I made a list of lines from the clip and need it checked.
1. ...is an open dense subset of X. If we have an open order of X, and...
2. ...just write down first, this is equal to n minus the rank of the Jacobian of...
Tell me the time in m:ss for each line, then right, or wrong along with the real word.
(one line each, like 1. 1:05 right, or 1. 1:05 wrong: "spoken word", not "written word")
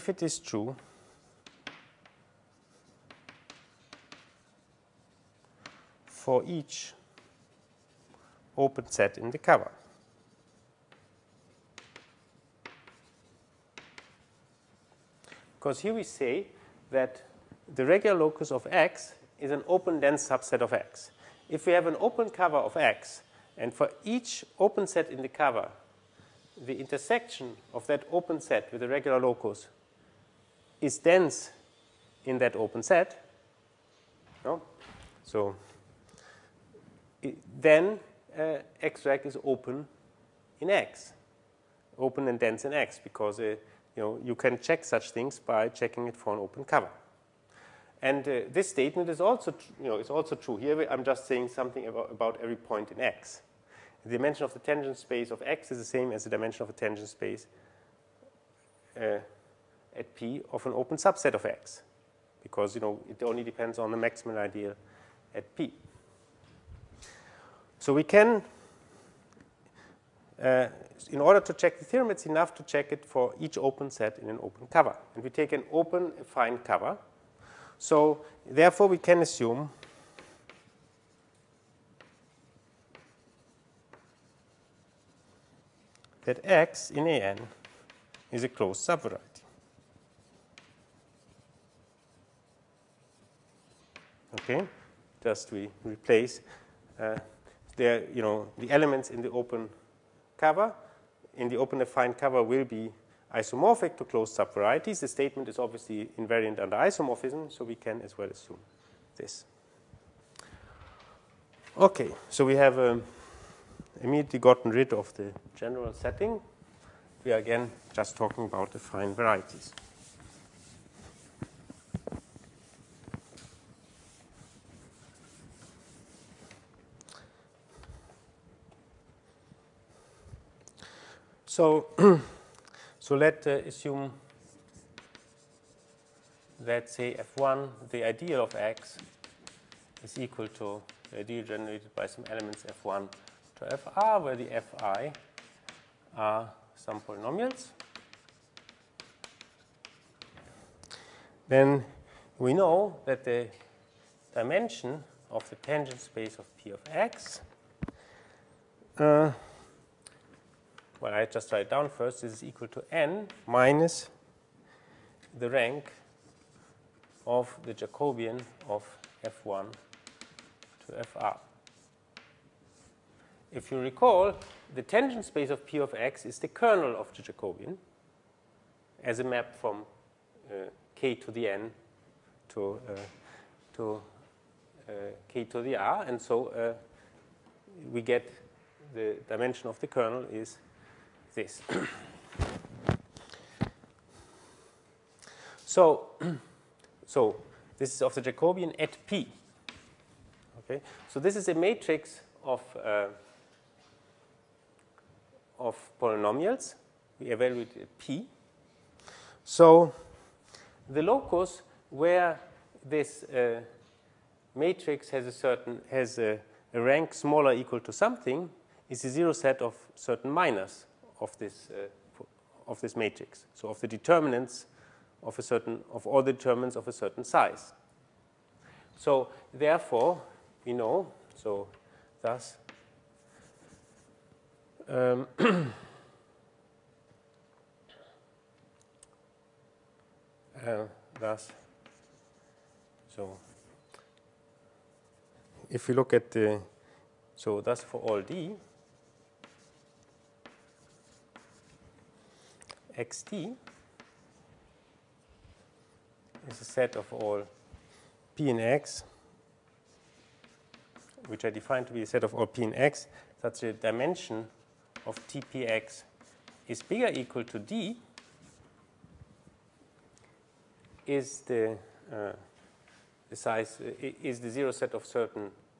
1. 0:19 wrong: "cover", not "order"
2. 2:41 right.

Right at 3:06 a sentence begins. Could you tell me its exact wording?
And so uh, we get the dimension of the kernel is this.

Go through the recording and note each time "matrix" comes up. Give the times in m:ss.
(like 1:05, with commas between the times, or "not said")
3:21, 3:34, 3:42.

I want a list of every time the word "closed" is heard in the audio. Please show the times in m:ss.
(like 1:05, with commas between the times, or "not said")
1:28, 1:44.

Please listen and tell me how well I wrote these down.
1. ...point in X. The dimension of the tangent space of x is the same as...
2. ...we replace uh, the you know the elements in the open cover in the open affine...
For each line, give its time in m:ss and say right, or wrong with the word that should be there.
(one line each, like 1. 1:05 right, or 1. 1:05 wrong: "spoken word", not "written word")
1. 0:52 right
2. 1:35 right.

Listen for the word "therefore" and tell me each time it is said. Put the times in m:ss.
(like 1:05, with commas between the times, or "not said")
1:18, 3:49.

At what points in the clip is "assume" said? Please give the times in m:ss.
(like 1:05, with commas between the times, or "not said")
1:19, 1:48, 2:13.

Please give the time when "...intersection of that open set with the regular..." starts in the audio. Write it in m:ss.
0:26.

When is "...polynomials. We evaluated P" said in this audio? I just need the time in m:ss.
3:25.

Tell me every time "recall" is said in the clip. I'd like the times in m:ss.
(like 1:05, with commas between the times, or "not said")
2:53.